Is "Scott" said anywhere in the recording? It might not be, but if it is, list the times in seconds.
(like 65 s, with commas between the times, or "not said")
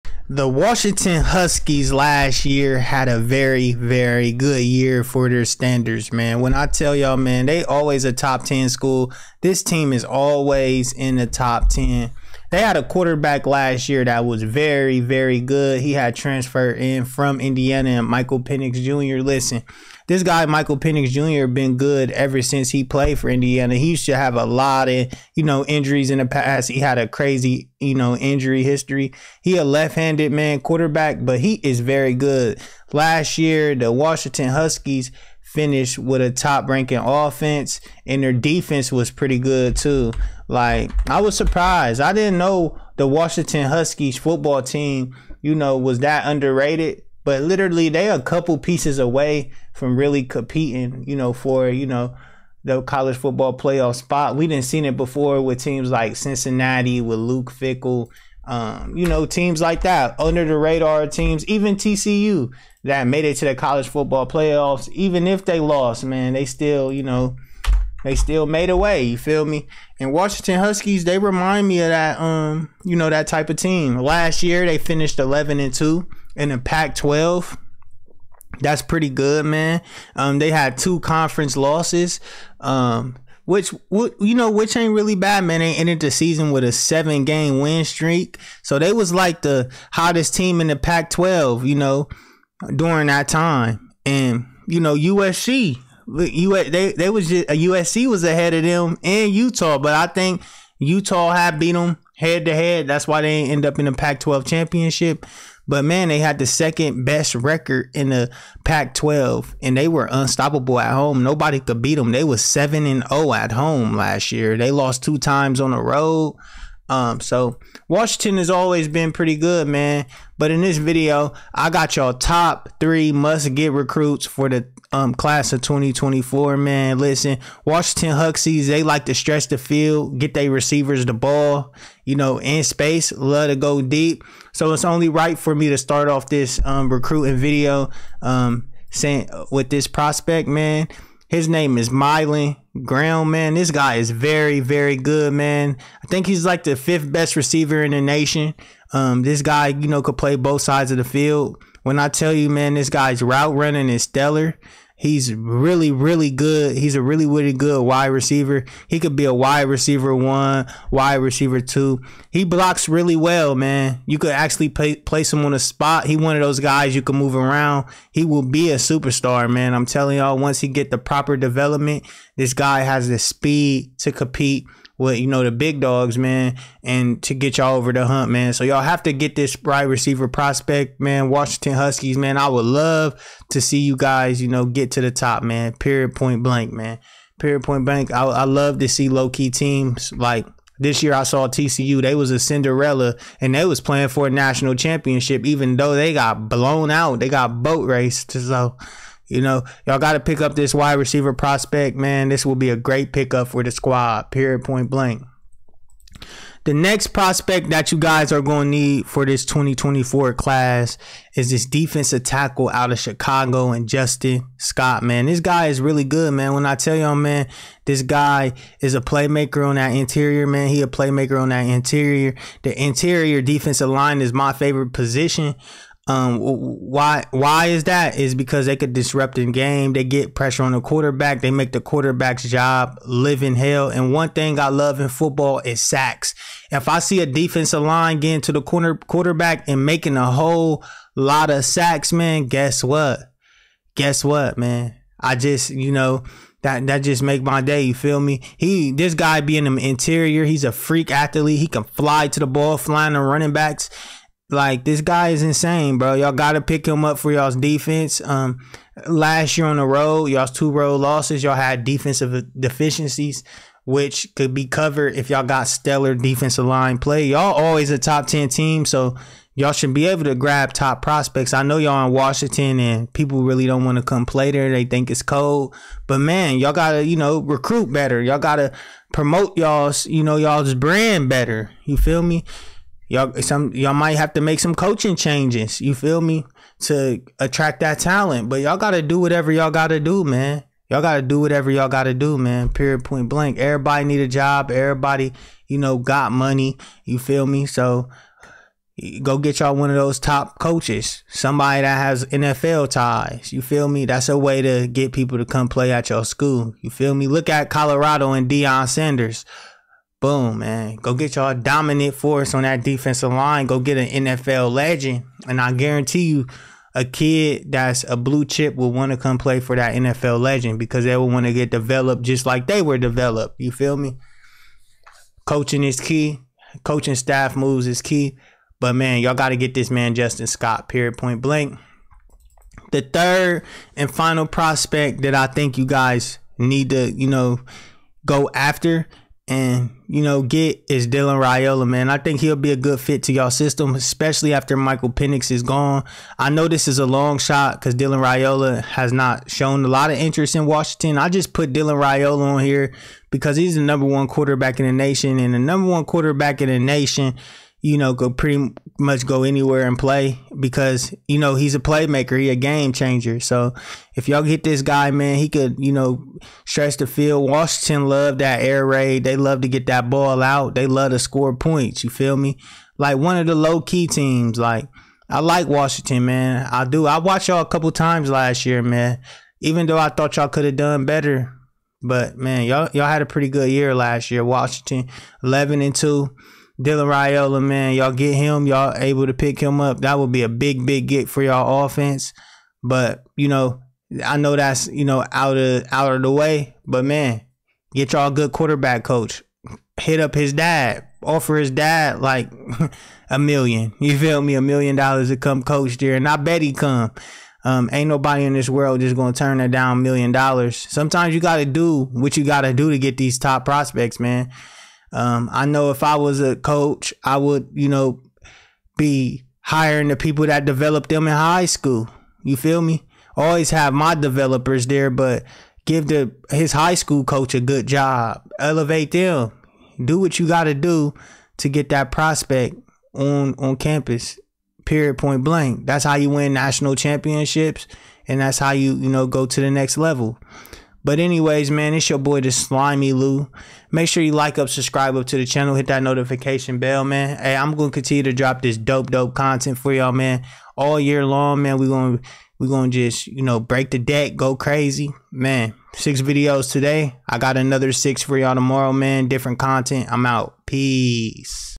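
214 s, 330 s.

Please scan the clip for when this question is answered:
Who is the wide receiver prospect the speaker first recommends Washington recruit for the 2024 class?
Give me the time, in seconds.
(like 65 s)
141 s.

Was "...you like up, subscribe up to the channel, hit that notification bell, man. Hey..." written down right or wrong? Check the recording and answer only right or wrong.
right.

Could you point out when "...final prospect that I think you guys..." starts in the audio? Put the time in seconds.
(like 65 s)
334 s.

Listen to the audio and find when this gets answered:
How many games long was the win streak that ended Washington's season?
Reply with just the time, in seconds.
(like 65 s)
86 s.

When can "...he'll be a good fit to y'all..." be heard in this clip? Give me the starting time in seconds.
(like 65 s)
342 s.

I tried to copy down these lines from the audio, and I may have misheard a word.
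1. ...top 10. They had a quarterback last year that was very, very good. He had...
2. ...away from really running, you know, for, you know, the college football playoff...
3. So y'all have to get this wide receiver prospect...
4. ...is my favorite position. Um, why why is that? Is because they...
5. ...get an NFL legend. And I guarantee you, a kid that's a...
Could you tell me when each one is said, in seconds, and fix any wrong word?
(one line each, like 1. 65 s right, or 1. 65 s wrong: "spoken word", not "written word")
1. 11 s right
2. 48 s wrong: "competing", not "running"
3. 178 s right
4. 224 s right
5. 313 s right.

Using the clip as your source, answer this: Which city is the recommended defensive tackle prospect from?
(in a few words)
Chicago.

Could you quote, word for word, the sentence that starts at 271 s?
I know y'all in Washington and people really don't want to come play there.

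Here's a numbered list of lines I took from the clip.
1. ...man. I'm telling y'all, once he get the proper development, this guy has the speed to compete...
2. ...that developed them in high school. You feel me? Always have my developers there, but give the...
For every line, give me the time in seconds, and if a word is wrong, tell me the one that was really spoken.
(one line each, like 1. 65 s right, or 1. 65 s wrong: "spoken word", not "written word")
1. 169 s right
2. 420 s right.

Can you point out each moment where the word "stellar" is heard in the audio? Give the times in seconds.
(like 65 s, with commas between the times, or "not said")
154 s, 265 s.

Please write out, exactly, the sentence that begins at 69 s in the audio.
And Washington Huskies, they remind me of that um, you know, that type of team.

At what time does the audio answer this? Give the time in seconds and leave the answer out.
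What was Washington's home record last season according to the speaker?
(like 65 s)
112 s.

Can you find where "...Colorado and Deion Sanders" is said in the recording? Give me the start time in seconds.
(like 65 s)
307 s.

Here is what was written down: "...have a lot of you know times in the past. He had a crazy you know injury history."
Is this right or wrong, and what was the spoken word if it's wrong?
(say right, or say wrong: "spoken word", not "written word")
wrong: "injuries", not "times".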